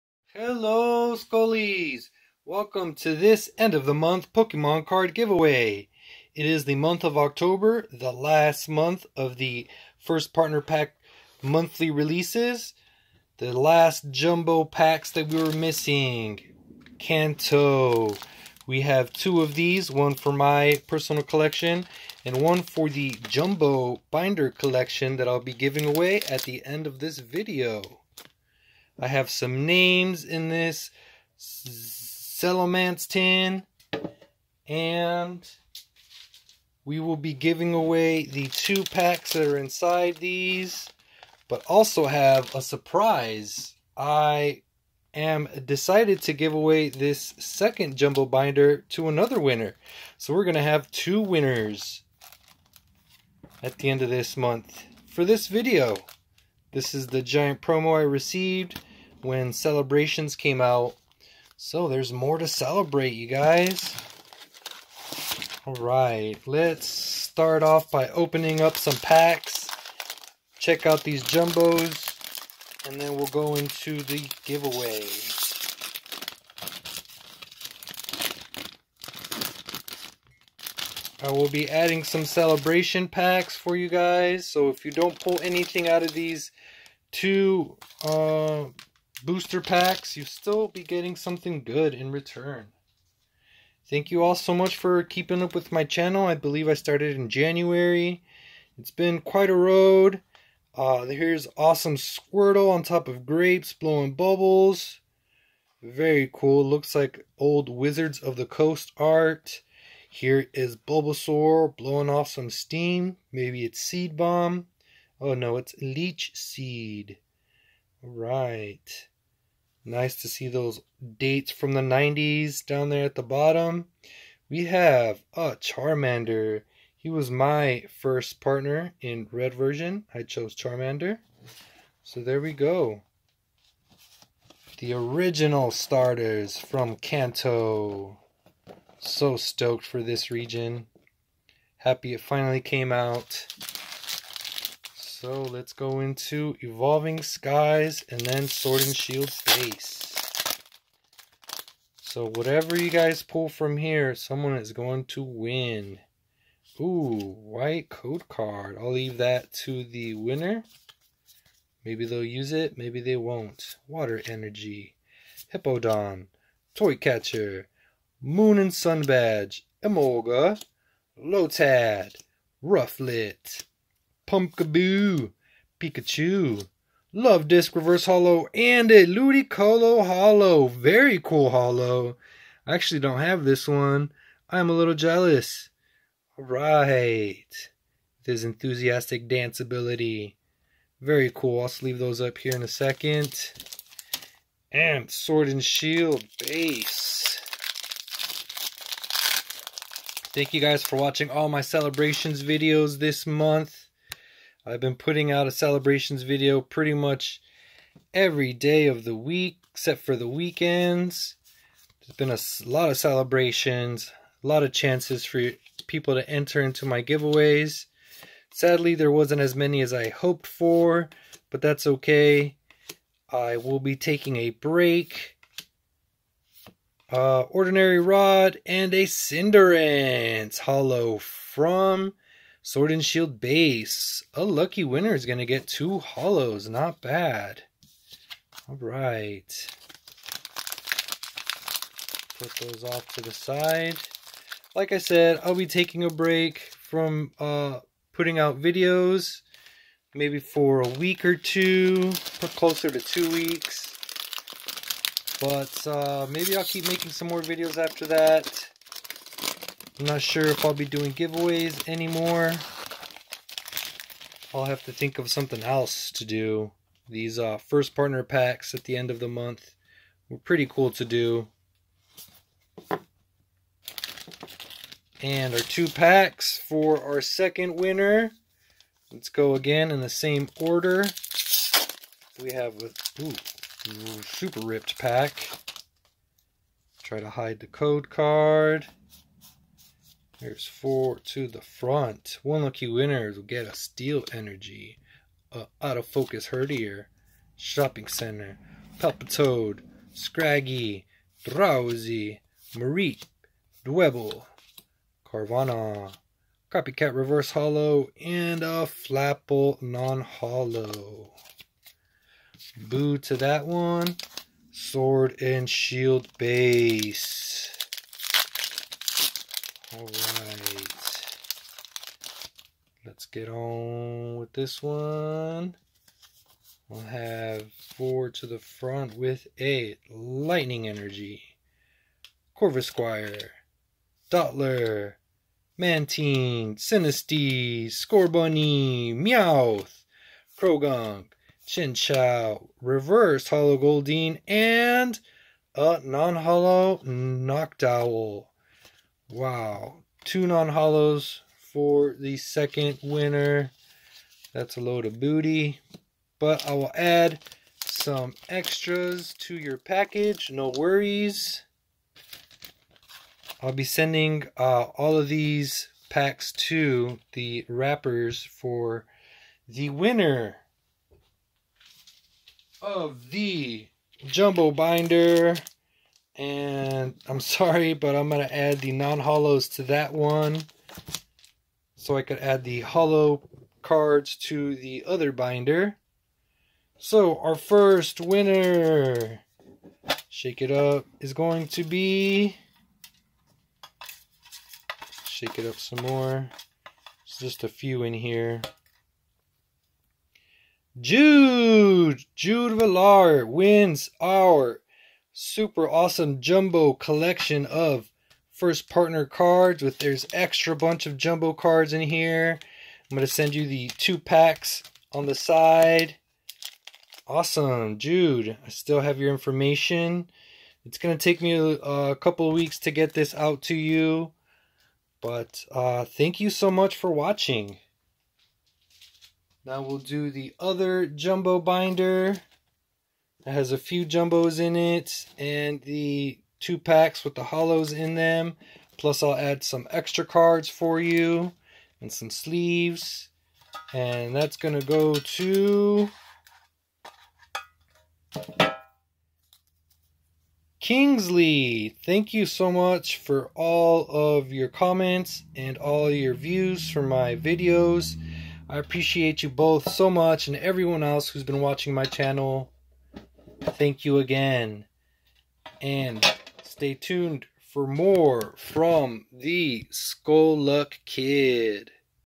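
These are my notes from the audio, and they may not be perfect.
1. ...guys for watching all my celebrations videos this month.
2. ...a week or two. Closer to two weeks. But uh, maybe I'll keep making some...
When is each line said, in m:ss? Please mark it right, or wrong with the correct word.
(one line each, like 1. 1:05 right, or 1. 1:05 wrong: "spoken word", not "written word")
1. 3:20 right
2. 4:10 right.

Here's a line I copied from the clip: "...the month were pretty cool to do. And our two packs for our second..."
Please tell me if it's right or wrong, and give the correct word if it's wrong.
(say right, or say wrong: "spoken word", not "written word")
right.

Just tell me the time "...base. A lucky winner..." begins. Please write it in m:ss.
3:53.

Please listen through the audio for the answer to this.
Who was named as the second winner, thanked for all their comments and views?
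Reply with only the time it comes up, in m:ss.
7:30.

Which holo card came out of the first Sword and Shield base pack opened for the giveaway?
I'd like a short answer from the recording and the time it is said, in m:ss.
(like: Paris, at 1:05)
Cinderace, at 3:49.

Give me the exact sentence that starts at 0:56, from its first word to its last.
This is the giant promo I received when Celebrations came out.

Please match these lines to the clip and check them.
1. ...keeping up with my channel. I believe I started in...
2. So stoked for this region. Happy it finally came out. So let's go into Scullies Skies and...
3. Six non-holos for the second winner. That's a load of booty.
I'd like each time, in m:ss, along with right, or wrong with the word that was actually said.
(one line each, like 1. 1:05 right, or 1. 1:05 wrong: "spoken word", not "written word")
1. 1:35 right
2. 2:18 wrong: "Evolving", not "Scullies"
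3. 5:50 wrong: "Two", not "Six".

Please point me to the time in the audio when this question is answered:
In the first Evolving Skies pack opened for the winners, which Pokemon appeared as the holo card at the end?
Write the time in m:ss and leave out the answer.
2:59.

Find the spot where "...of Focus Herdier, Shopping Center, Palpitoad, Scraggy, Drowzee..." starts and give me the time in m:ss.
4:55.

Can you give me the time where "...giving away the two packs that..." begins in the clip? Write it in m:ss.
0:37.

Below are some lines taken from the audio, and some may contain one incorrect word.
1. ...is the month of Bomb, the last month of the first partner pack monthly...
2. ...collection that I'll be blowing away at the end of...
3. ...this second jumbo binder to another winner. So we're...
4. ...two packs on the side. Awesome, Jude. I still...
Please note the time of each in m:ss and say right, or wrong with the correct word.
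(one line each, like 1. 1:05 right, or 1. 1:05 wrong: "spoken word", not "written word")
1. 0:06 wrong: "October", not "Bomb"
2. 0:24 wrong: "giving", not "blowing"
3. 0:46 right
4. 6:53 right.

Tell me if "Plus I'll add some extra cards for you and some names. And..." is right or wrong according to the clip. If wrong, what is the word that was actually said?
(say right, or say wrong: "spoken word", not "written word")
wrong: "sleeves", not "names".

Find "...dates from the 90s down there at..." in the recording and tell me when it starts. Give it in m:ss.
2:01.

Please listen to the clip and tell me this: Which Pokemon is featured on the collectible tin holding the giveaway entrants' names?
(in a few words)
Salamence.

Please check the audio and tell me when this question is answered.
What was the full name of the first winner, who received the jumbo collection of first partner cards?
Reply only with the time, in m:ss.
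6:42.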